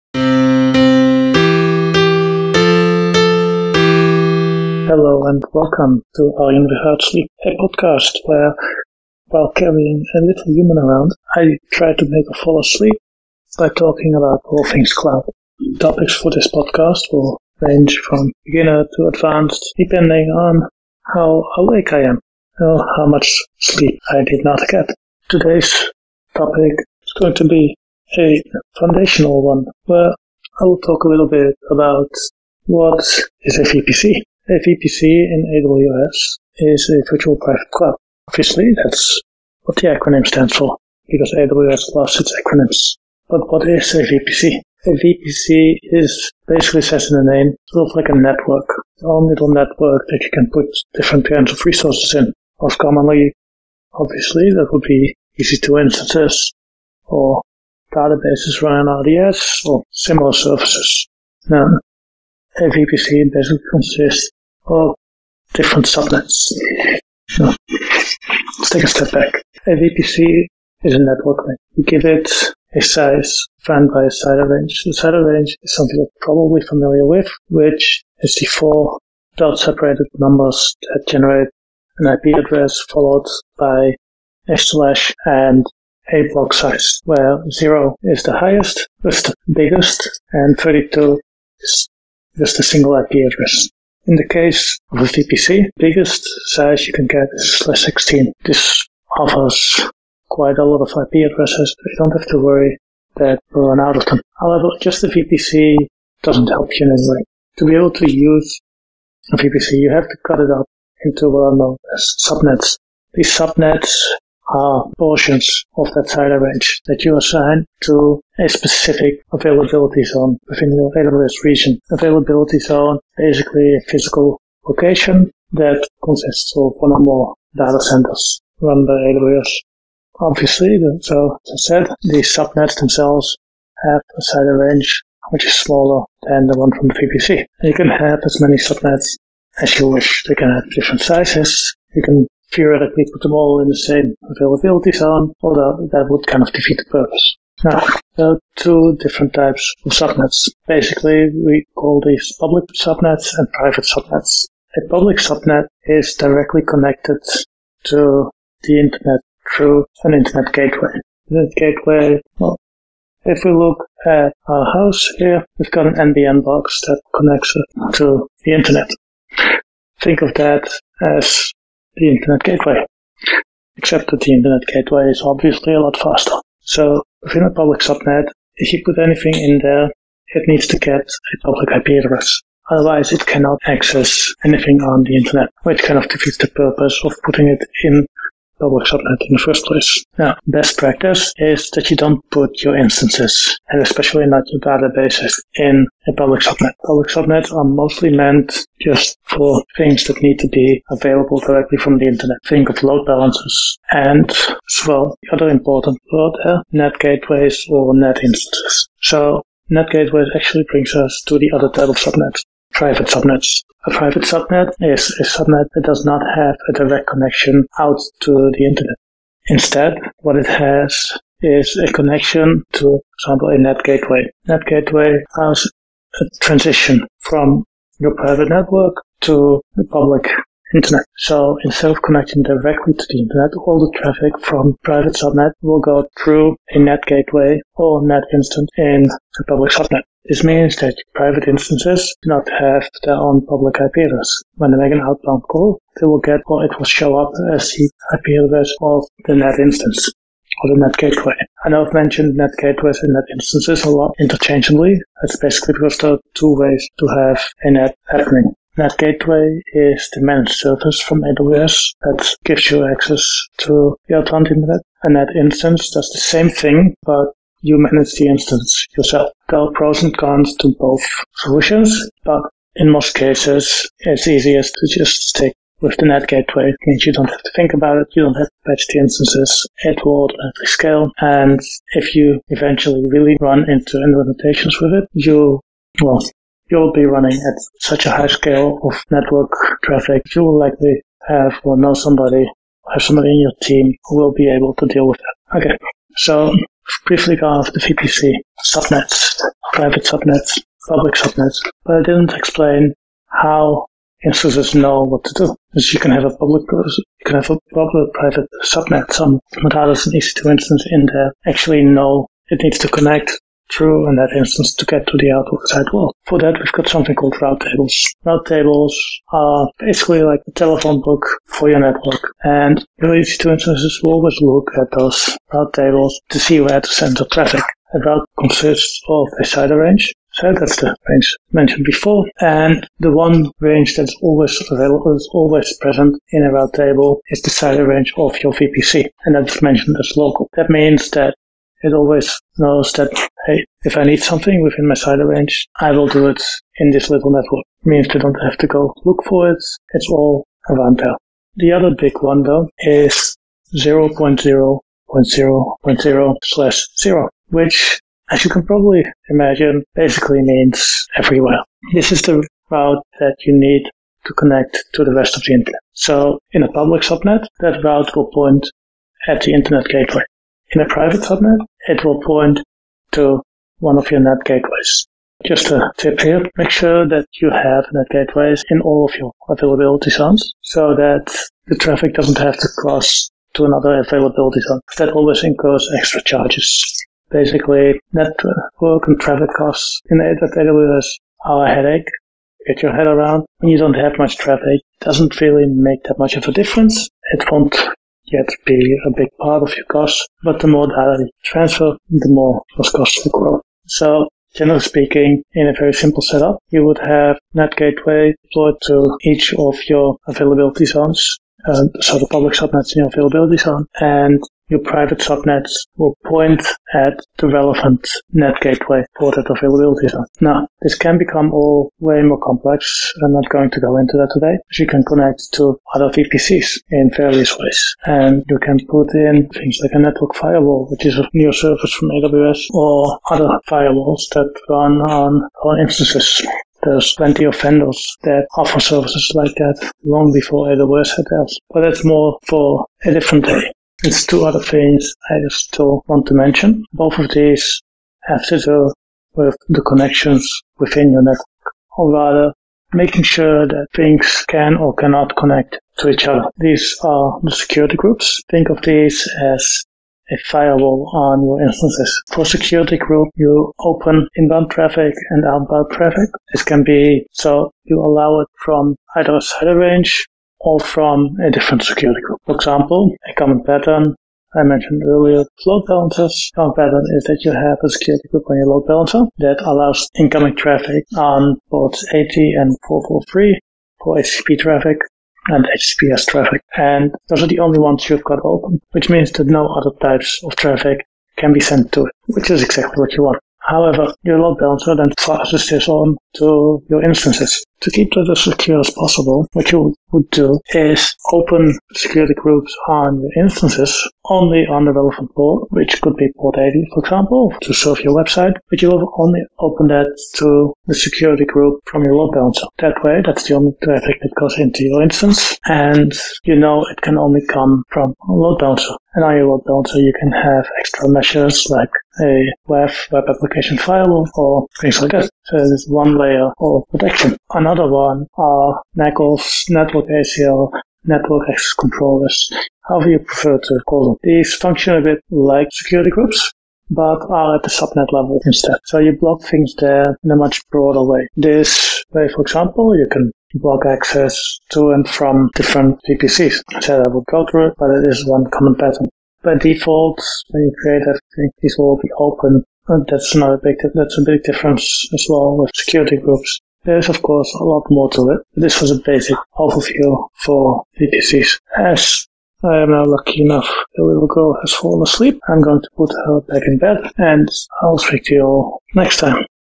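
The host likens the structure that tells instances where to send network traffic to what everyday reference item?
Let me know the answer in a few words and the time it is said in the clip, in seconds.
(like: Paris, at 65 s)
Telephone book, at 320 s.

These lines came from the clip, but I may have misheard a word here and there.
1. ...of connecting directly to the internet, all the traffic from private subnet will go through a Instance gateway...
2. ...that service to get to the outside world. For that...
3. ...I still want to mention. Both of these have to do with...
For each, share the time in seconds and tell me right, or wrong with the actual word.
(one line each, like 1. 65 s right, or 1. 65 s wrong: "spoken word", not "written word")
1. 231 s wrong: "NAT", not "Instance"
2. 314 s wrong: "instance", not "service"
3. 445 s right.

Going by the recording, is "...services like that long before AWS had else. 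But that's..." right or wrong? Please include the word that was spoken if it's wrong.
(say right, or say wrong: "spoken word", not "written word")
right.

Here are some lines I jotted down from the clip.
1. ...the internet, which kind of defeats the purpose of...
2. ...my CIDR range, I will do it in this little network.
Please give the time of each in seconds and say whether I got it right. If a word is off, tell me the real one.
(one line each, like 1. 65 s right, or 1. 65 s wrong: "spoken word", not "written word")
1. 185 s right
2. 344 s right.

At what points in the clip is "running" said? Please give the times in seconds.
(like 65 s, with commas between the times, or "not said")
58 s, 287 s.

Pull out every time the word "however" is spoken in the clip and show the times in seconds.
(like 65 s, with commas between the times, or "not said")
104 s, 493 s, 532 s.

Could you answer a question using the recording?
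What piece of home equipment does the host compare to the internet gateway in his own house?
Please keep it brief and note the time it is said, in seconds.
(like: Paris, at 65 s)
NBN box, at 165 s.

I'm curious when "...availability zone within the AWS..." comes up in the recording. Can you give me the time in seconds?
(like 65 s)
119 s.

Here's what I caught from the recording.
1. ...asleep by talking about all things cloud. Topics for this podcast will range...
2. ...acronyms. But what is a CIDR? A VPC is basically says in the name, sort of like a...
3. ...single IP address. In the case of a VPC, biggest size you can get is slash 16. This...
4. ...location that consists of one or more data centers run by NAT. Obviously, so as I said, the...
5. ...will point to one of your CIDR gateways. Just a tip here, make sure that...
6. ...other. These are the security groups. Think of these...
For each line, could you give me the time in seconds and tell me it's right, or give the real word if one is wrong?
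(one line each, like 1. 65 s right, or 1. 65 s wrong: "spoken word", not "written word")
1. 12 s right
2. 42 s wrong: "VPC", not "CIDR"
3. 92 s right
4. 124 s wrong: "AWS", not "NAT"
5. 372 s wrong: "NAT", not "CIDR"
6. 456 s right.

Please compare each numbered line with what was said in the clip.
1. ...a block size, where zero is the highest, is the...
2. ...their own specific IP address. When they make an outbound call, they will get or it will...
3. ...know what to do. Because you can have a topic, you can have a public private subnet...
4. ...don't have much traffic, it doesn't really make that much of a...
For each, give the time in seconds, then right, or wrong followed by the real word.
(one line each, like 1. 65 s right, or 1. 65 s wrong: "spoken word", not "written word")
1. 86 s right
2. 243 s wrong: "public", not "specific"
3. 304 s wrong: "public", not "topic"
4. 393 s right.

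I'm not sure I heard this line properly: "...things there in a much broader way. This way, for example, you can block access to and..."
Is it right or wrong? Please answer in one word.
right.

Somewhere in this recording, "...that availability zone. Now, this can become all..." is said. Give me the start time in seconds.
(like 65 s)
419 s.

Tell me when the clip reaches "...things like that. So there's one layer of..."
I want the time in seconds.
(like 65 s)
524 s.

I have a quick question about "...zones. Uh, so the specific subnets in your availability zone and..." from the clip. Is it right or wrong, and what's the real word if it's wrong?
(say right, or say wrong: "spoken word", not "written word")
wrong: "public", not "specific".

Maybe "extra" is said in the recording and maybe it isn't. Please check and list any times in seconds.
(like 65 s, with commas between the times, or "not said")
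385 s, 520 s.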